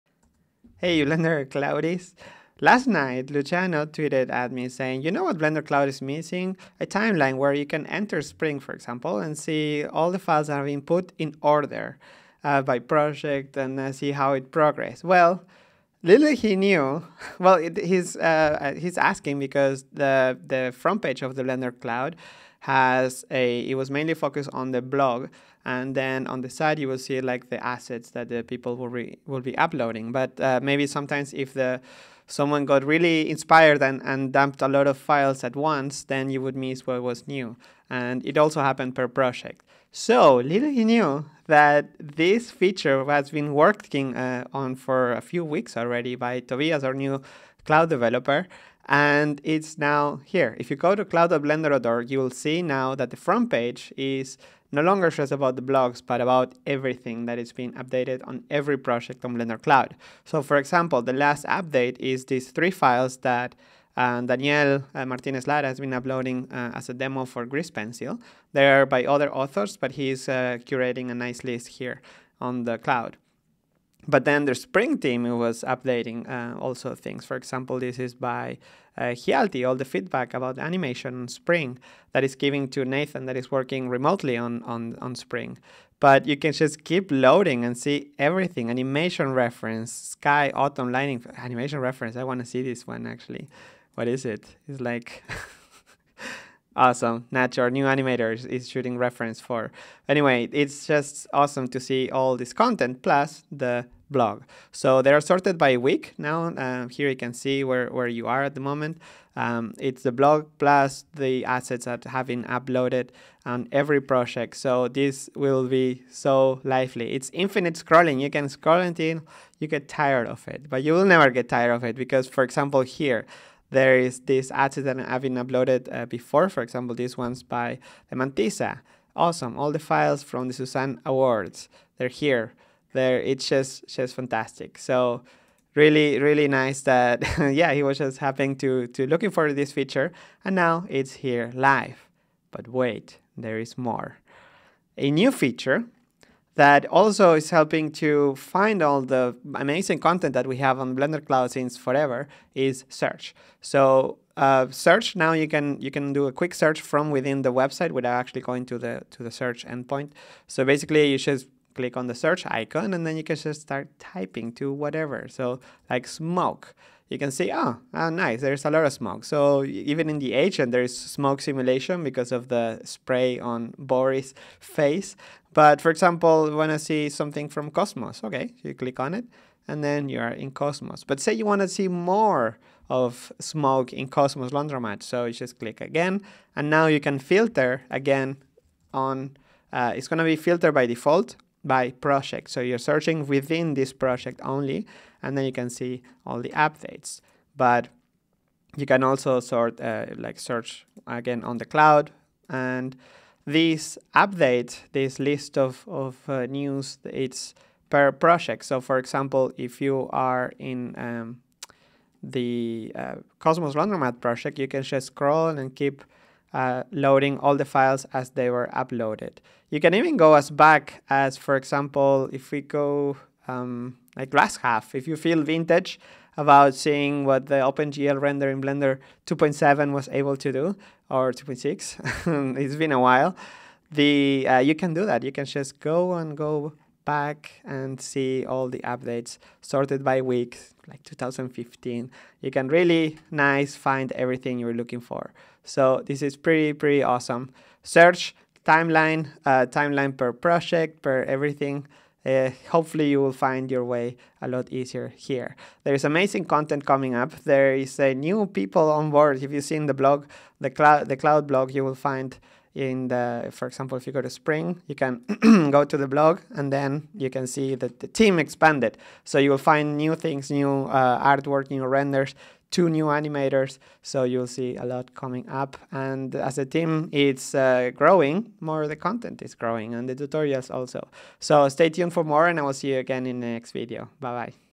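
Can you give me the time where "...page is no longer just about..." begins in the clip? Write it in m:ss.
0:53.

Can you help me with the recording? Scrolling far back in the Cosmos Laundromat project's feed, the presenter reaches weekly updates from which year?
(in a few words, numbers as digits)
2015.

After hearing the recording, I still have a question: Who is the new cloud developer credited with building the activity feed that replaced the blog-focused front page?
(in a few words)
Tobias.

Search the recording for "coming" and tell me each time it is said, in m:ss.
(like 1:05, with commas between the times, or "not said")
4:16, 4:35.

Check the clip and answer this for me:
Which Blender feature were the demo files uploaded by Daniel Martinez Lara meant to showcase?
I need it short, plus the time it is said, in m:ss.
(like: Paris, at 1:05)
Grease Pencil, at 1:07.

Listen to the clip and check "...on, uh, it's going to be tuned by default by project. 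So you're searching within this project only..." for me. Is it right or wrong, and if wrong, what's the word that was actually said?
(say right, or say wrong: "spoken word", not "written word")
wrong: "filtered", not "tuned".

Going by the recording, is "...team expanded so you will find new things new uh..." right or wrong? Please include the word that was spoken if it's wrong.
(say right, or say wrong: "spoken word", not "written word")
right.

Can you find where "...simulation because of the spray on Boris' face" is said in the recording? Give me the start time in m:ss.
2:51.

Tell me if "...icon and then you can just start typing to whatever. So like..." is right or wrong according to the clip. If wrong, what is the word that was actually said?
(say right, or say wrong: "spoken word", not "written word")
right.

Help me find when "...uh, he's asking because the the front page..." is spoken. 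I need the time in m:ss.
0:18.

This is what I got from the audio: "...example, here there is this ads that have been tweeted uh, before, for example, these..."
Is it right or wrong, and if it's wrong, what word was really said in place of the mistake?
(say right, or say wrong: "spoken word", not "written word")
wrong: "uploaded", not "tweeted".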